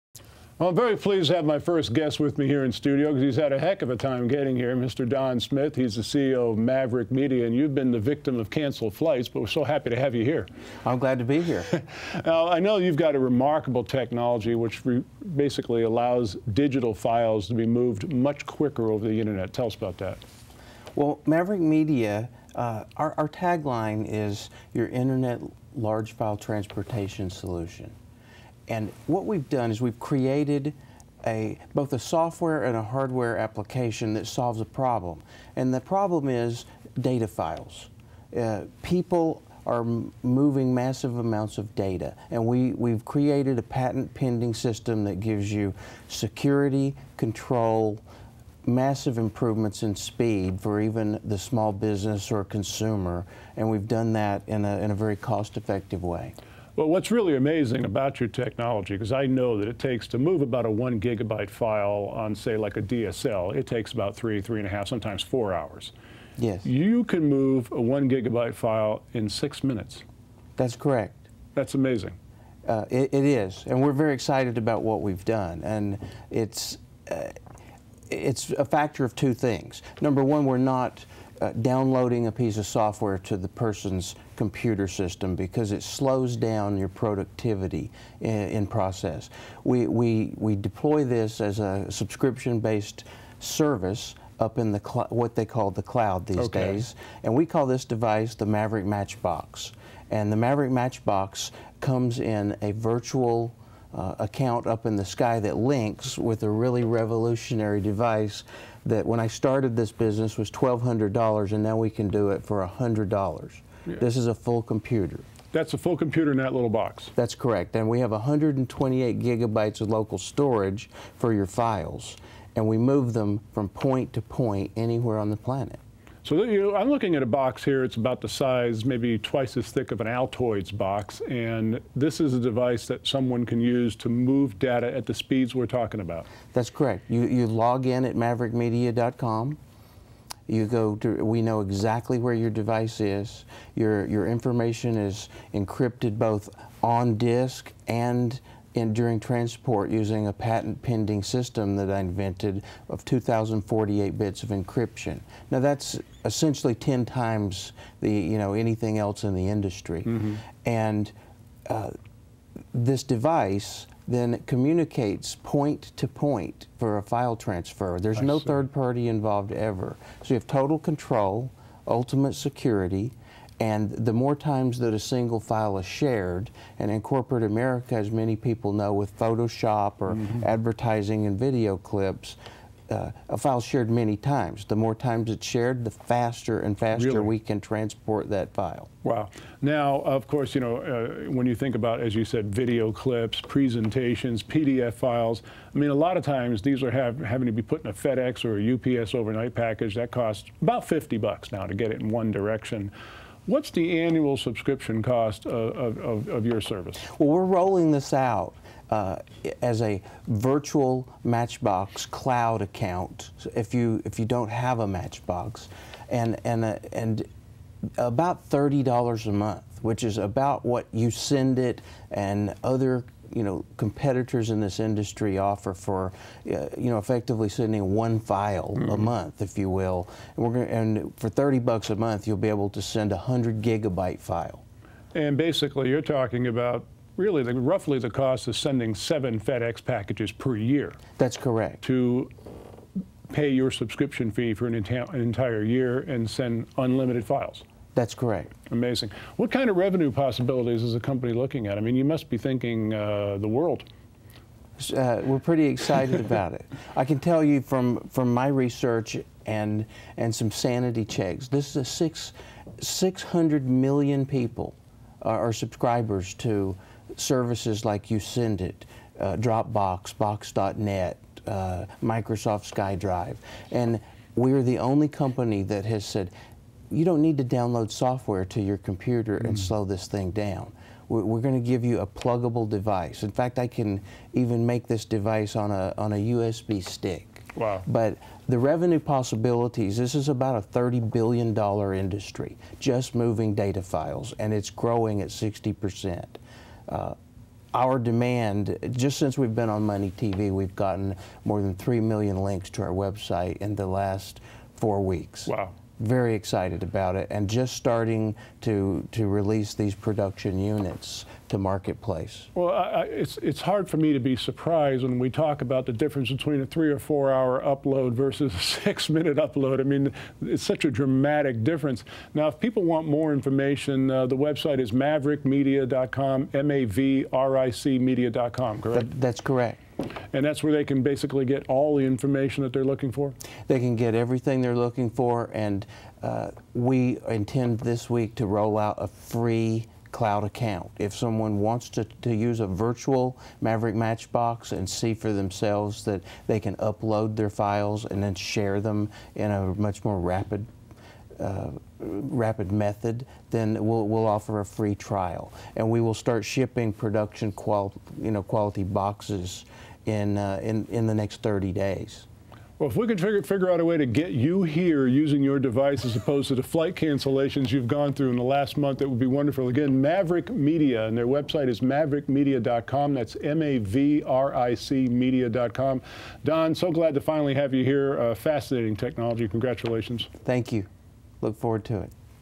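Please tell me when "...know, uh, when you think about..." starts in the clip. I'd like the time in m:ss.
3:10.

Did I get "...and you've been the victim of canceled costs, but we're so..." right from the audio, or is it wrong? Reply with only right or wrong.
wrong.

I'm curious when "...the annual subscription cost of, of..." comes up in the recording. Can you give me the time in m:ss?
3:23.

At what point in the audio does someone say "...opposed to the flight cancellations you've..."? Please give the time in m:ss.
6:06.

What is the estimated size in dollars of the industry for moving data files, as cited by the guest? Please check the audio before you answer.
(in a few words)
$30 billion.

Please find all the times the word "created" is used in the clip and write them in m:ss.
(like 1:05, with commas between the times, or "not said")
0:29, 0:43.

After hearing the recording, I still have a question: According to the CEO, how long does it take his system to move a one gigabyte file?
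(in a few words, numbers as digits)
6 minutes.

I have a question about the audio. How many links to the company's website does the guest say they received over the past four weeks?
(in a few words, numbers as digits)
3 million.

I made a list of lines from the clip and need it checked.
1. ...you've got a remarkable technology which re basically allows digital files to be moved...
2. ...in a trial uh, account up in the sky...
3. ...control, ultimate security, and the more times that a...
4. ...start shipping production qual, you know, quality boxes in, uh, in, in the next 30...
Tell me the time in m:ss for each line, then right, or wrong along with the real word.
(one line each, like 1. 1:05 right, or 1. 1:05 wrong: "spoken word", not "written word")
1. 0:12 right
2. 1:42 wrong: "virtual", not "trial"
3. 2:50 right
4. 5:56 right.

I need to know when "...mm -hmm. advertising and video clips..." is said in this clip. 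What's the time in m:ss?
3:00.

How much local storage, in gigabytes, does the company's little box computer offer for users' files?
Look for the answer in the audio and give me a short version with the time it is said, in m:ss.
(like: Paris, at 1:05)
128 gigabytes, at 1:58.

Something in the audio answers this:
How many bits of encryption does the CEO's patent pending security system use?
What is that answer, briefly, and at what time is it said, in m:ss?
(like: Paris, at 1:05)
2048, at 2:33.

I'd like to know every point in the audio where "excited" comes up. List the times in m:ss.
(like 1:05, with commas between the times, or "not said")
1:14, 4:15, 5:06.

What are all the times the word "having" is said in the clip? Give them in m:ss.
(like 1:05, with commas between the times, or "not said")
3:17.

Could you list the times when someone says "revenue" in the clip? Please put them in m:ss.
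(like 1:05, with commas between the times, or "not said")
4:09, 4:48.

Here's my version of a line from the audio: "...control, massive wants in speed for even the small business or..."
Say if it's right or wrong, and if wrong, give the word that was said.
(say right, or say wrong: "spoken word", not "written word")
wrong: "improvements", not "wants".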